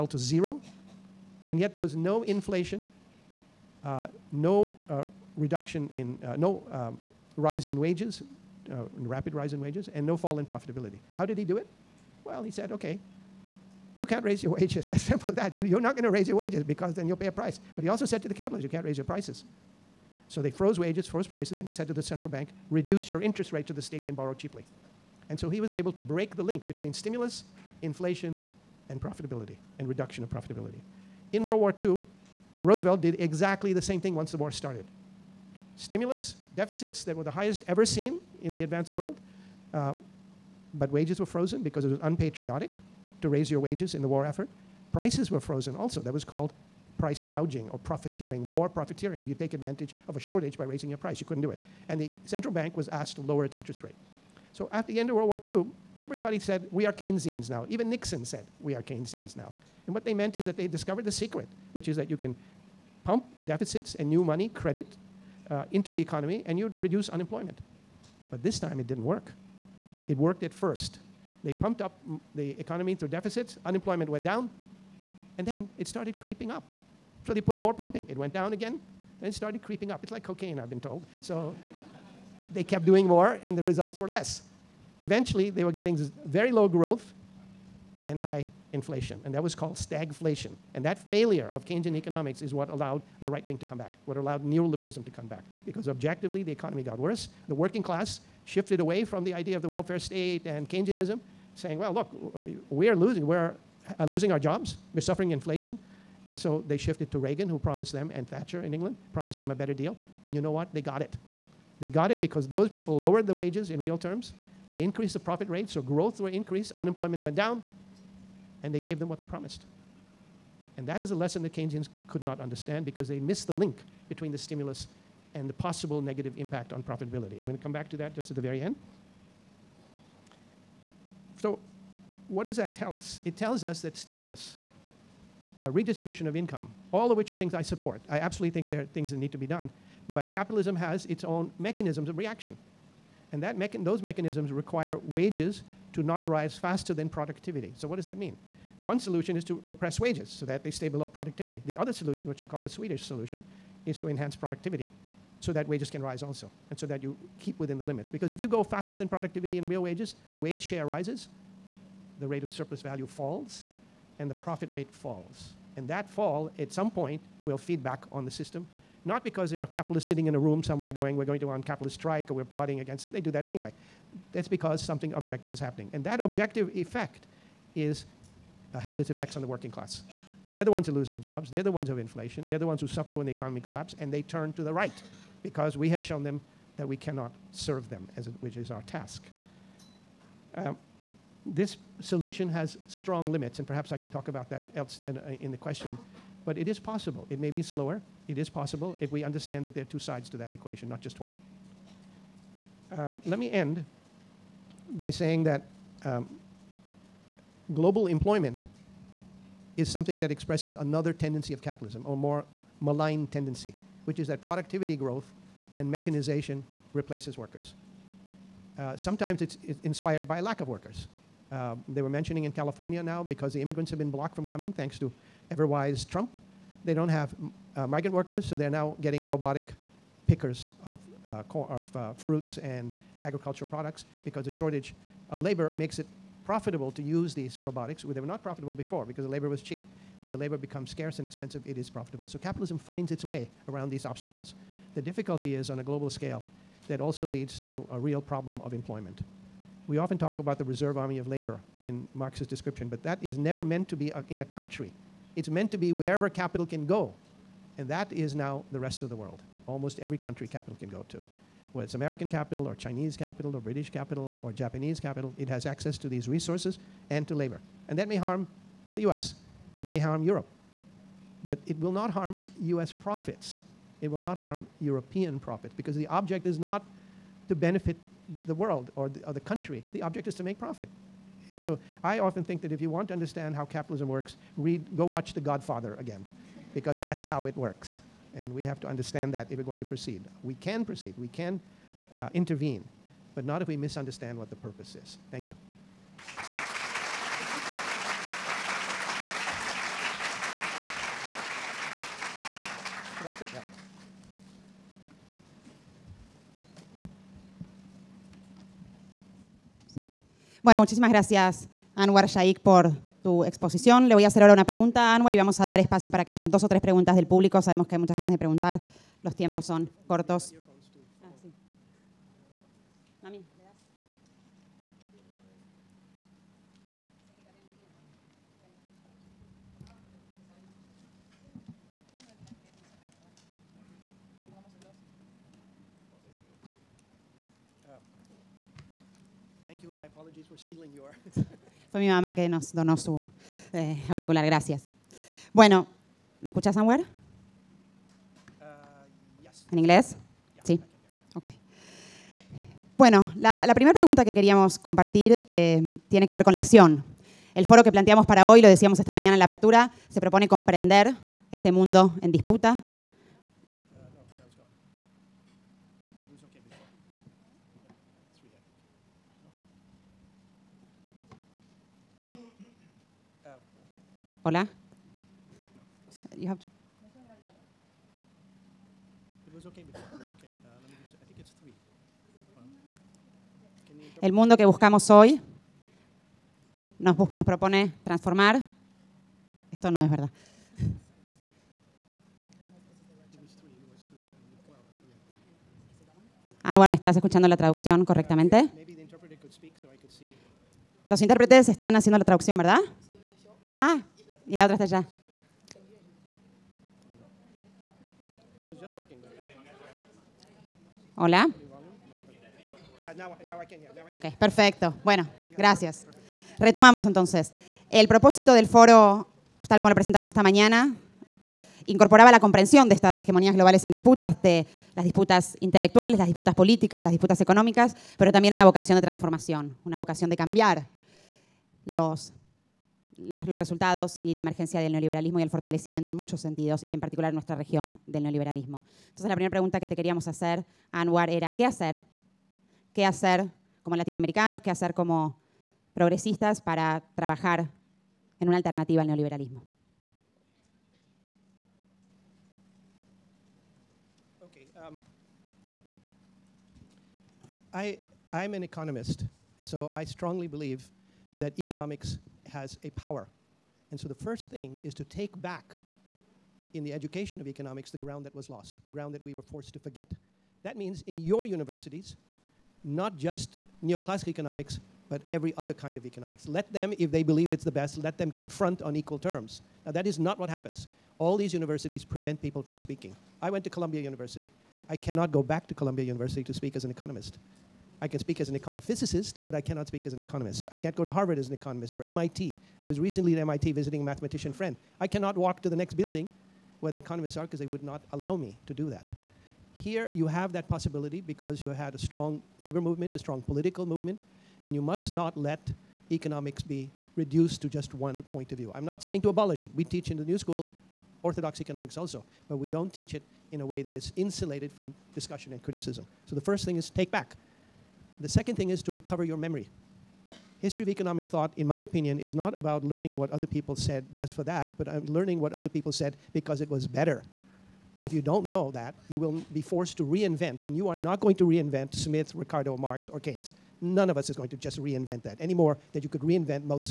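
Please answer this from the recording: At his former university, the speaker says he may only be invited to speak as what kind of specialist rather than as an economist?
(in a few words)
econophysicist.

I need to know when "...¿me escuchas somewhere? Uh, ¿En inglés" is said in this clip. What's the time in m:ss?
5:46.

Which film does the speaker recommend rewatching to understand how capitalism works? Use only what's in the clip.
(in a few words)
The Godfather.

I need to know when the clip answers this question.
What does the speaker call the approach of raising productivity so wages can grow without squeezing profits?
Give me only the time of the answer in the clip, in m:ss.
2:32.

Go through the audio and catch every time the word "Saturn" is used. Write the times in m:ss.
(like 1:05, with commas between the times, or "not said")
not said.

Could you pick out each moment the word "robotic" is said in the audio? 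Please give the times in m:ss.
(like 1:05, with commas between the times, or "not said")
3:49, 3:57.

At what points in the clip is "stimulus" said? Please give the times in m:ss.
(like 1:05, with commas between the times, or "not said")
0:26, 0:35, 2:04, 2:13.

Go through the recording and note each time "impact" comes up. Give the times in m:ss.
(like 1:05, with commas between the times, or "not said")
2:06.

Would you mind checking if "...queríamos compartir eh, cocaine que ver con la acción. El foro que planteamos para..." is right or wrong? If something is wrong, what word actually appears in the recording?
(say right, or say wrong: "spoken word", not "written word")
wrong: "tiene", not "cocaine".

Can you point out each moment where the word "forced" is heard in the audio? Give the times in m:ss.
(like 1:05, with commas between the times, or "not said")
7:49, 8:49.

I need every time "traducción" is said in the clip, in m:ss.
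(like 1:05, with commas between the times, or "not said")
6:37, 6:42.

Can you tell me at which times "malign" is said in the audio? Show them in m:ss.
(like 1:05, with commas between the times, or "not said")
3:32.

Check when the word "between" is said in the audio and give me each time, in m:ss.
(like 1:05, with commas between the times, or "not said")
0:26, 2:04.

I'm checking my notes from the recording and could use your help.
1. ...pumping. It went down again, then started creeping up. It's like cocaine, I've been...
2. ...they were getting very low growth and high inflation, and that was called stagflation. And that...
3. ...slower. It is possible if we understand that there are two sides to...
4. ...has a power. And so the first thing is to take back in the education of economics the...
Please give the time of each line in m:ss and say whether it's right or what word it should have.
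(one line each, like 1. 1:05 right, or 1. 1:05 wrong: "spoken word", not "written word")
1. 1:17 right
2. 1:25 right
3. 3:17 right
4. 7:42 right.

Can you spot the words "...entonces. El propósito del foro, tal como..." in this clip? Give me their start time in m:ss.
6:57.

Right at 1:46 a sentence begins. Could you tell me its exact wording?
And so they shifted to Reagan, who promised them, and Thatcher in England promised them a better deal.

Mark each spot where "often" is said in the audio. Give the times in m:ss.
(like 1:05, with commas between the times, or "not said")
4:09, 4:42.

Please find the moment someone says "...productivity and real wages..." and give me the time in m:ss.
2:39.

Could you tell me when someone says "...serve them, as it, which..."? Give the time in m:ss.
3:07.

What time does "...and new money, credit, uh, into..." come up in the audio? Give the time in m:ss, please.
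1:03.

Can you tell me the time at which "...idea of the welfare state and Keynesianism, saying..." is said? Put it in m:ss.
1:39.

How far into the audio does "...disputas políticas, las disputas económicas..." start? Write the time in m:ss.
7:06.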